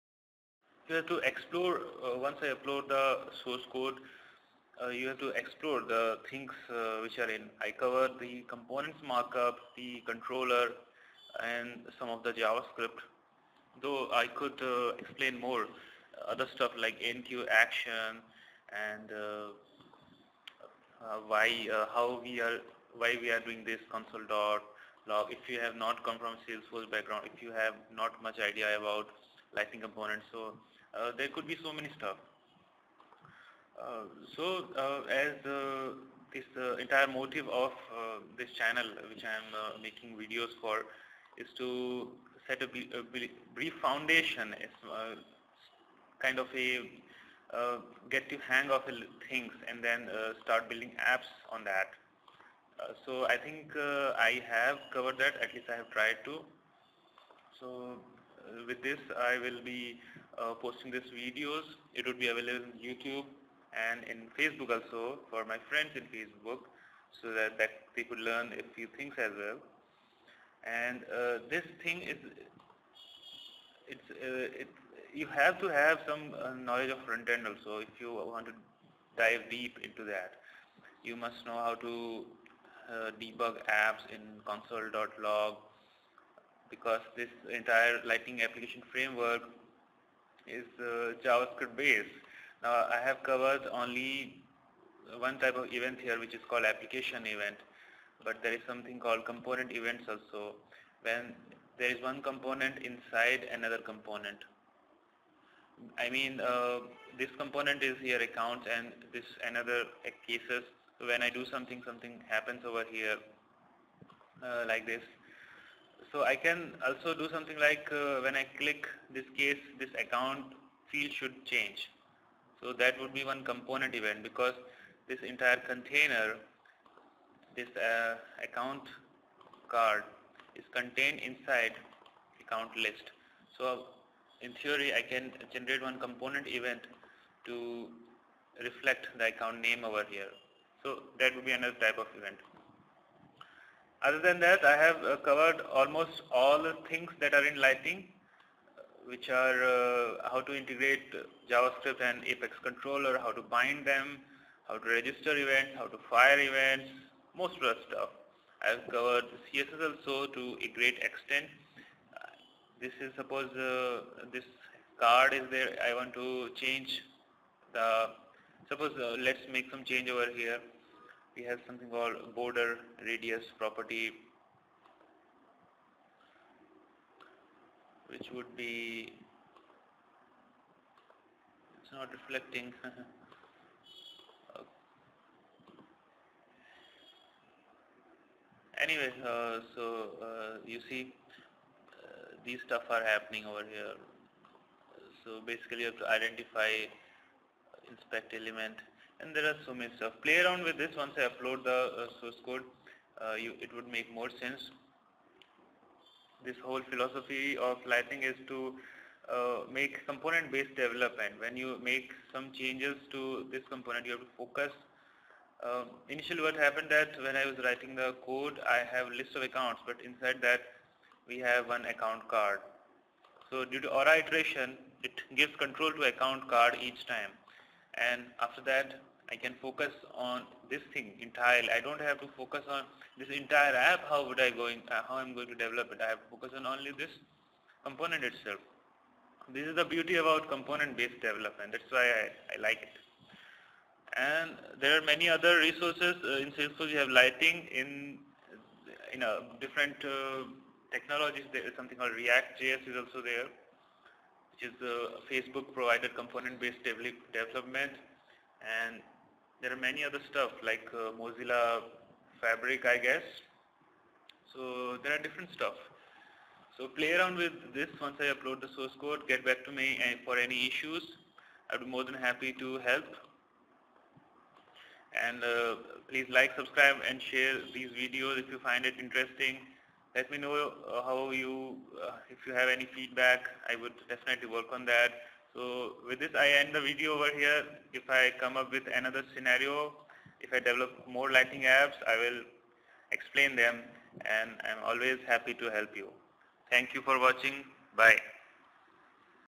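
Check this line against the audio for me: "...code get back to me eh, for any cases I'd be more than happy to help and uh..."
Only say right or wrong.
wrong.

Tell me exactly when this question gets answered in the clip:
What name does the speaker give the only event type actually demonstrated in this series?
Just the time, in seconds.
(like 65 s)
96 s.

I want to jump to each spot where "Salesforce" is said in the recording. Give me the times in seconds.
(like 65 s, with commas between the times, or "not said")
26 s, 246 s.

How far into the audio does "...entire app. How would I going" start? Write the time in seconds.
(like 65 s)
233 s.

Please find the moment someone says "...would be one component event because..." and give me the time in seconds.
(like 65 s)
122 s.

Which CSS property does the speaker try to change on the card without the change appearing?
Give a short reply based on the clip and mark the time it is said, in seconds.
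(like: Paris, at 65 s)
border radius, at 172 s.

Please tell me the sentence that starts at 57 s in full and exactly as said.
So uh, with this I will be uh, posting these videos.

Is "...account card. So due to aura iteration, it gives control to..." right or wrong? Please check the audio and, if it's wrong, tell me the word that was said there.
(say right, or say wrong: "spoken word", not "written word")
right.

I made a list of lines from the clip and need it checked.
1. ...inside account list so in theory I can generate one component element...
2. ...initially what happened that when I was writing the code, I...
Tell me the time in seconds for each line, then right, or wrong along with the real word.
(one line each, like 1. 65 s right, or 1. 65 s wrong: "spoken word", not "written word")
1. 131 s wrong: "event", not "element"
2. 216 s right.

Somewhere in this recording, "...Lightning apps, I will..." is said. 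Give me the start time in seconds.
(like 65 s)
291 s.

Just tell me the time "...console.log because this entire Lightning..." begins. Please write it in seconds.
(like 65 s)
84 s.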